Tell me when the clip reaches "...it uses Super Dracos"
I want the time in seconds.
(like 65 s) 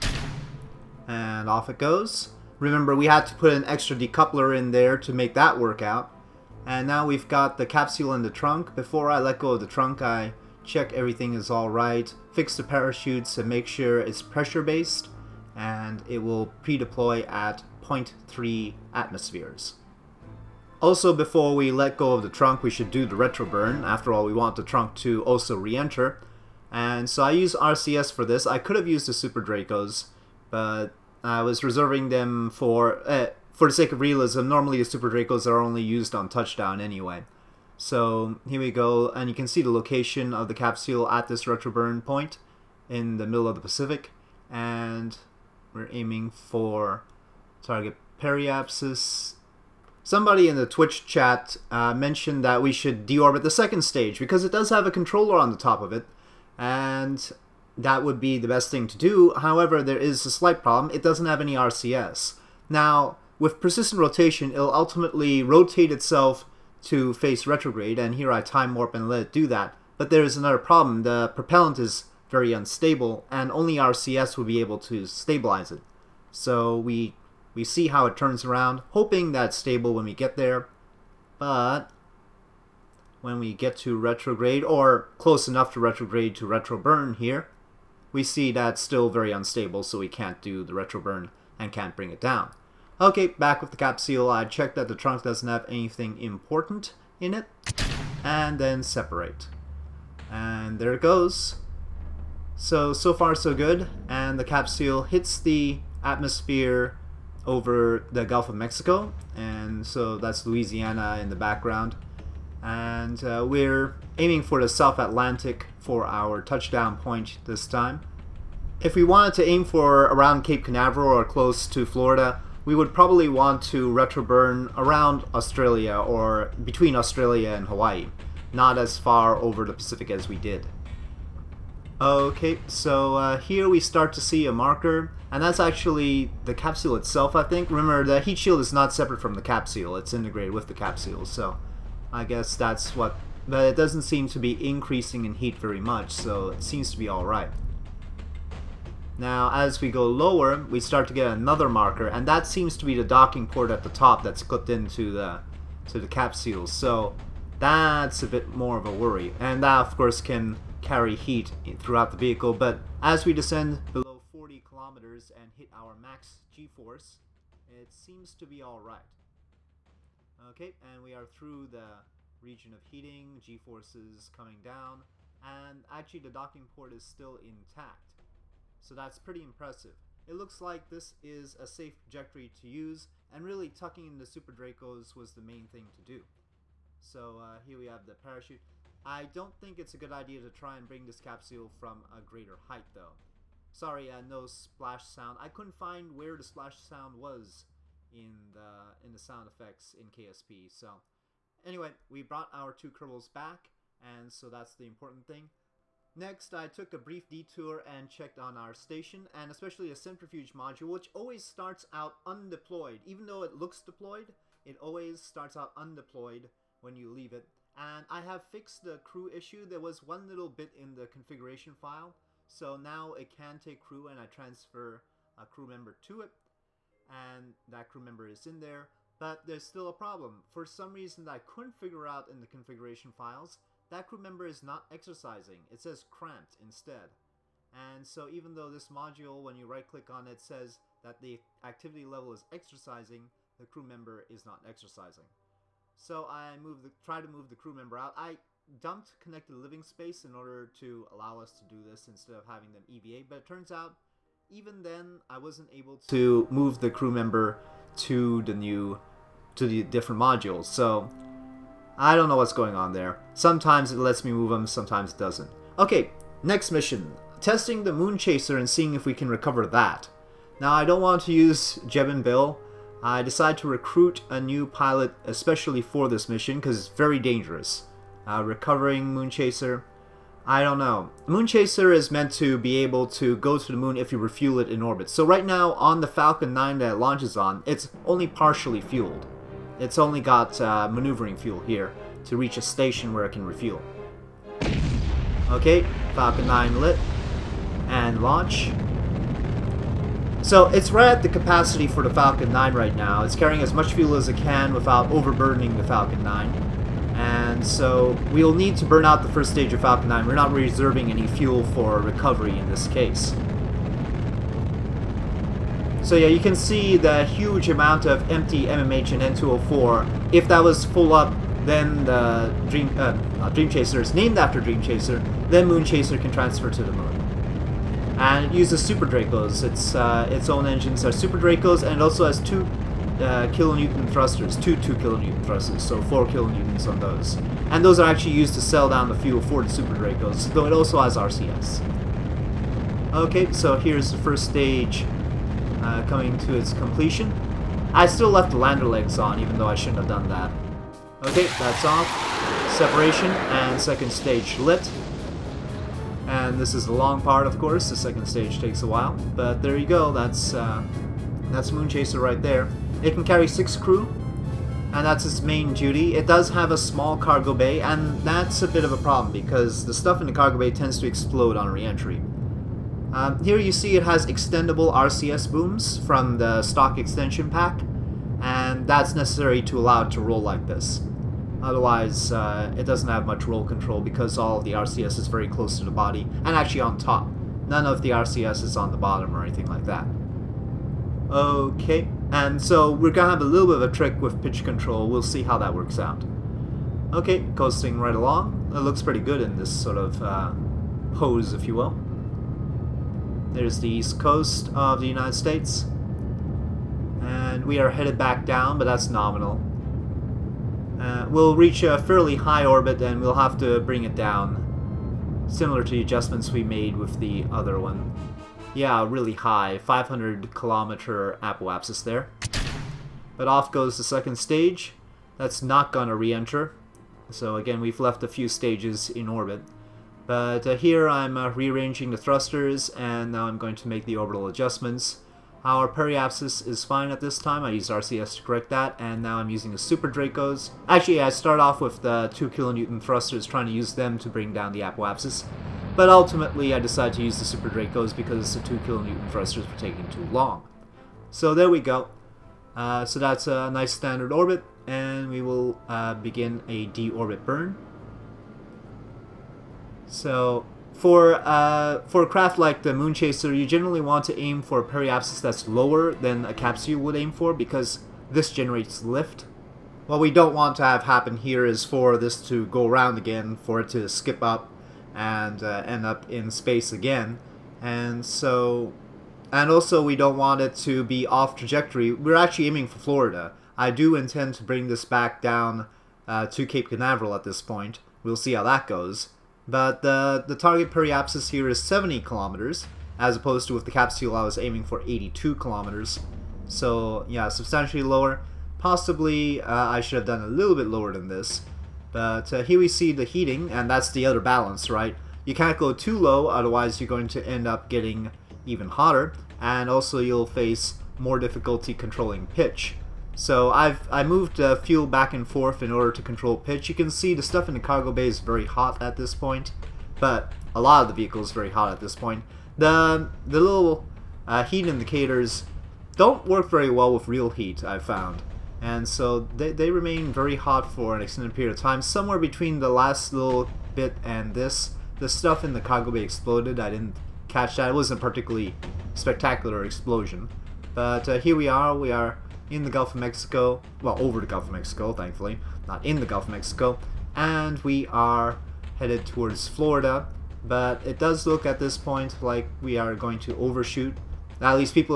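328 s.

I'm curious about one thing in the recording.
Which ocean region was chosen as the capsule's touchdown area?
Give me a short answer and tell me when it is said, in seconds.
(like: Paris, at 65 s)
South Atlantic, at 114 s.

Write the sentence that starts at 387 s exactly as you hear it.
None of the RCS is on the bottom or anything like that.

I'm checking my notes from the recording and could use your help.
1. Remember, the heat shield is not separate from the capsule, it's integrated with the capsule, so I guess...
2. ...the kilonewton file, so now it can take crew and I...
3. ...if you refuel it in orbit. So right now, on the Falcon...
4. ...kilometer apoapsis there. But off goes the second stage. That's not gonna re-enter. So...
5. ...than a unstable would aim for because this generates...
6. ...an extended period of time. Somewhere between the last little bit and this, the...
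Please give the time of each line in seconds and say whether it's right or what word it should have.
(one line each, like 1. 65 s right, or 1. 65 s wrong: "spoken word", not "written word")
1. 137 s right
2. 220 s wrong: "configuration", not "kilonewton"
3. 283 s right
4. 420 s right
5. 466 s wrong: "capsule", not "unstable"
6. 531 s right.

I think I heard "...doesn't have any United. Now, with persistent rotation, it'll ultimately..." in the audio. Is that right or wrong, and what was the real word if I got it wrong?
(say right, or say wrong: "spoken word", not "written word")
wrong: "RCS", not "United".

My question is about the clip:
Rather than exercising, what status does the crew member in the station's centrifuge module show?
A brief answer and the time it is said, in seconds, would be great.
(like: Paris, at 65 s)
Cramped, at 236 s.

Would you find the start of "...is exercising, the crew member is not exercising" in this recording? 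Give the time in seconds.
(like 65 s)
242 s.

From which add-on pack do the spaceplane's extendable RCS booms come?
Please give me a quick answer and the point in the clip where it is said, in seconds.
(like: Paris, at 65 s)
Stock extension pack, at 376 s.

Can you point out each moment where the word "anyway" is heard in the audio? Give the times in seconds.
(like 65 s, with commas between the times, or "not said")
36 s, 201 s.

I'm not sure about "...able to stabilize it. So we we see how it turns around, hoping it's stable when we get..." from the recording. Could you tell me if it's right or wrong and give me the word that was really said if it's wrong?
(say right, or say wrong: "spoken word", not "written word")
right.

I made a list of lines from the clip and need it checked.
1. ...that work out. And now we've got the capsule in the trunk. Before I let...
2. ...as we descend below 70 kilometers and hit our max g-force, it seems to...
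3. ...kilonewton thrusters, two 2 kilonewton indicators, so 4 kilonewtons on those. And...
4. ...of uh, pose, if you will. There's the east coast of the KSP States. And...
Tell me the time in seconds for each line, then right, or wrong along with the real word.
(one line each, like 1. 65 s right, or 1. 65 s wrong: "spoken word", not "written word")
1. 5 s right
2. 162 s wrong: "40", not "70"
3. 333 s wrong: "thrusters", not "indicators"
4. 399 s wrong: "United", not "KSP".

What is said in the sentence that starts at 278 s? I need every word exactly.
Uh, recovering Moon Chaser, I don't know.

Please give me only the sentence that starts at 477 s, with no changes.
And so, and also we don't want it to be off trajectory.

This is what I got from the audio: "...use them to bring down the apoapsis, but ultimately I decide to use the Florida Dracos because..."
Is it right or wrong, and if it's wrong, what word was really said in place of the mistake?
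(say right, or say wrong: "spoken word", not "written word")
wrong: "Super", not "Florida".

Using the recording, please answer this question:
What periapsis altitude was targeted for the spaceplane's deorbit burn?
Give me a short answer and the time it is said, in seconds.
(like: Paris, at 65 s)
70 kilometers, at 491 s.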